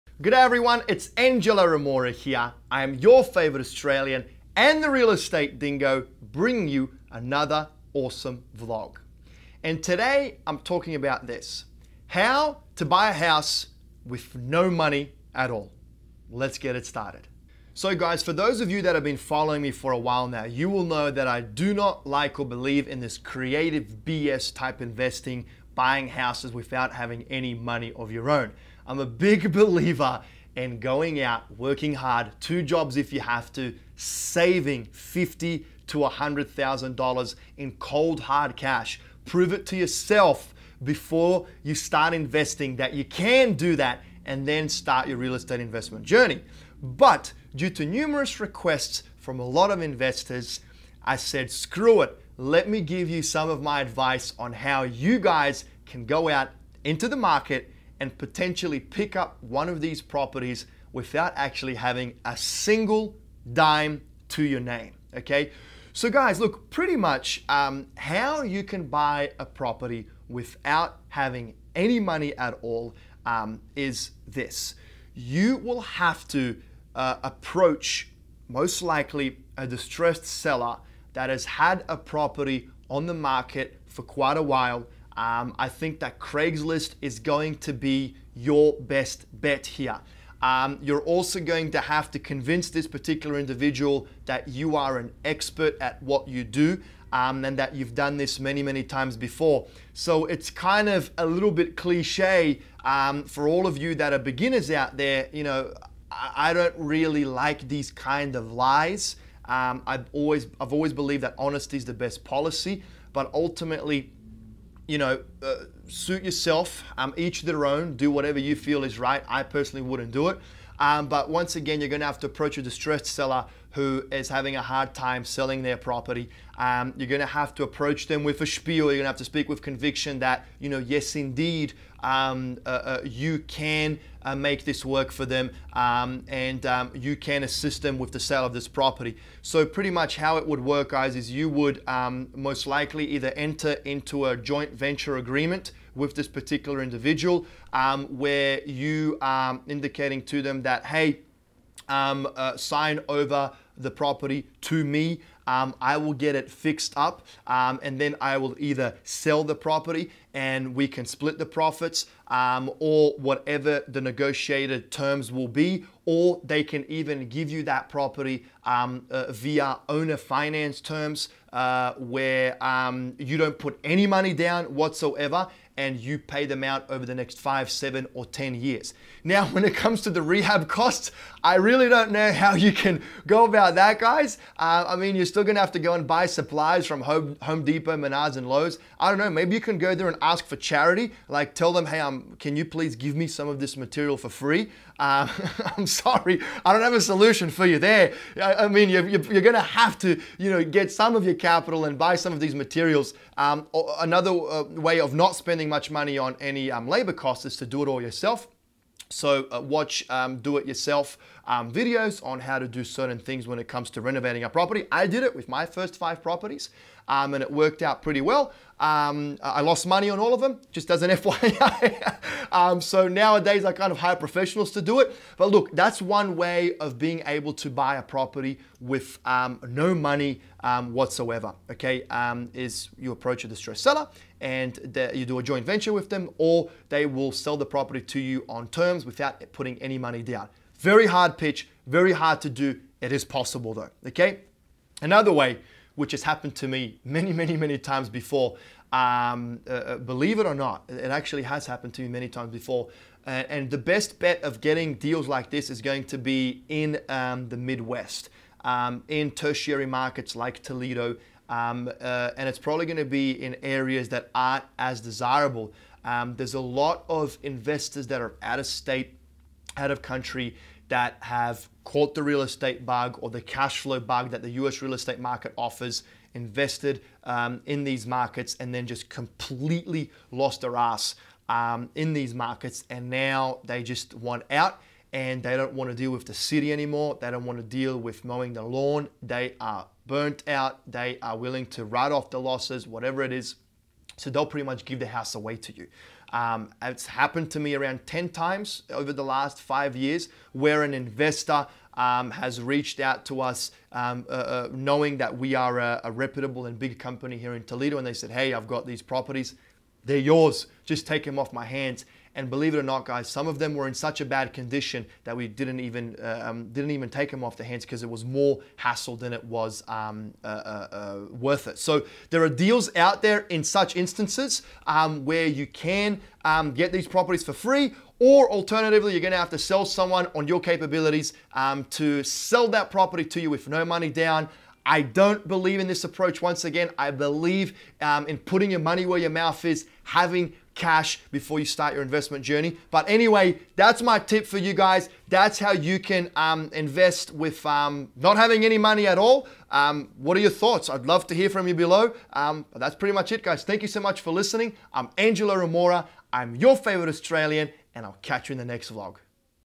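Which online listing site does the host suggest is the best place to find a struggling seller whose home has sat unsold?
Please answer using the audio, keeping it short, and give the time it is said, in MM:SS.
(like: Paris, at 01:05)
Craigslist, at 01:26.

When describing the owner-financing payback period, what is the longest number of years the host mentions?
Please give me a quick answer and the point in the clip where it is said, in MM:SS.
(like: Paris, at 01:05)
10, at 02:58.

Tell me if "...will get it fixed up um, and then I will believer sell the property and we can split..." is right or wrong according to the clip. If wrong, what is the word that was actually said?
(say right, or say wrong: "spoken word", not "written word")
wrong: "either", not "believer".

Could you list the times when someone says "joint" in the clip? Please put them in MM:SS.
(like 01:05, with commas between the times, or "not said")
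02:24, 03:55.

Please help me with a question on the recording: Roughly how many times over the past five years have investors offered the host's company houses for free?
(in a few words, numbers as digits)
10.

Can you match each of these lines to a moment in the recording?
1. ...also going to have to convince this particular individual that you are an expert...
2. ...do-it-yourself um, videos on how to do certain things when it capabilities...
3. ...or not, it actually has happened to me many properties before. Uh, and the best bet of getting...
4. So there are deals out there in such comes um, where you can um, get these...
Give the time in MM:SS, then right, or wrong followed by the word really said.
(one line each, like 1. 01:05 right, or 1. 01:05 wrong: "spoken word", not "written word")
1. 01:31 right
2. 03:30 wrong: "comes", not "capabilities"
3. 04:10 wrong: "times", not "properties"
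4. 05:21 wrong: "instances", not "comes".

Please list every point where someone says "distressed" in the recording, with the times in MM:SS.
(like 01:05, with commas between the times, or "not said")
01:19, 02:02, 03:53.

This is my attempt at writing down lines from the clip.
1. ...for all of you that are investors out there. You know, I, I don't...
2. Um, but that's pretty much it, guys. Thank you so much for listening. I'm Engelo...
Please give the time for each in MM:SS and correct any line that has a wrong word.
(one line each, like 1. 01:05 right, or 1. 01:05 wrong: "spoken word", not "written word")
1. 01:43 wrong: "beginners", not "investors"
2. 05:52 right.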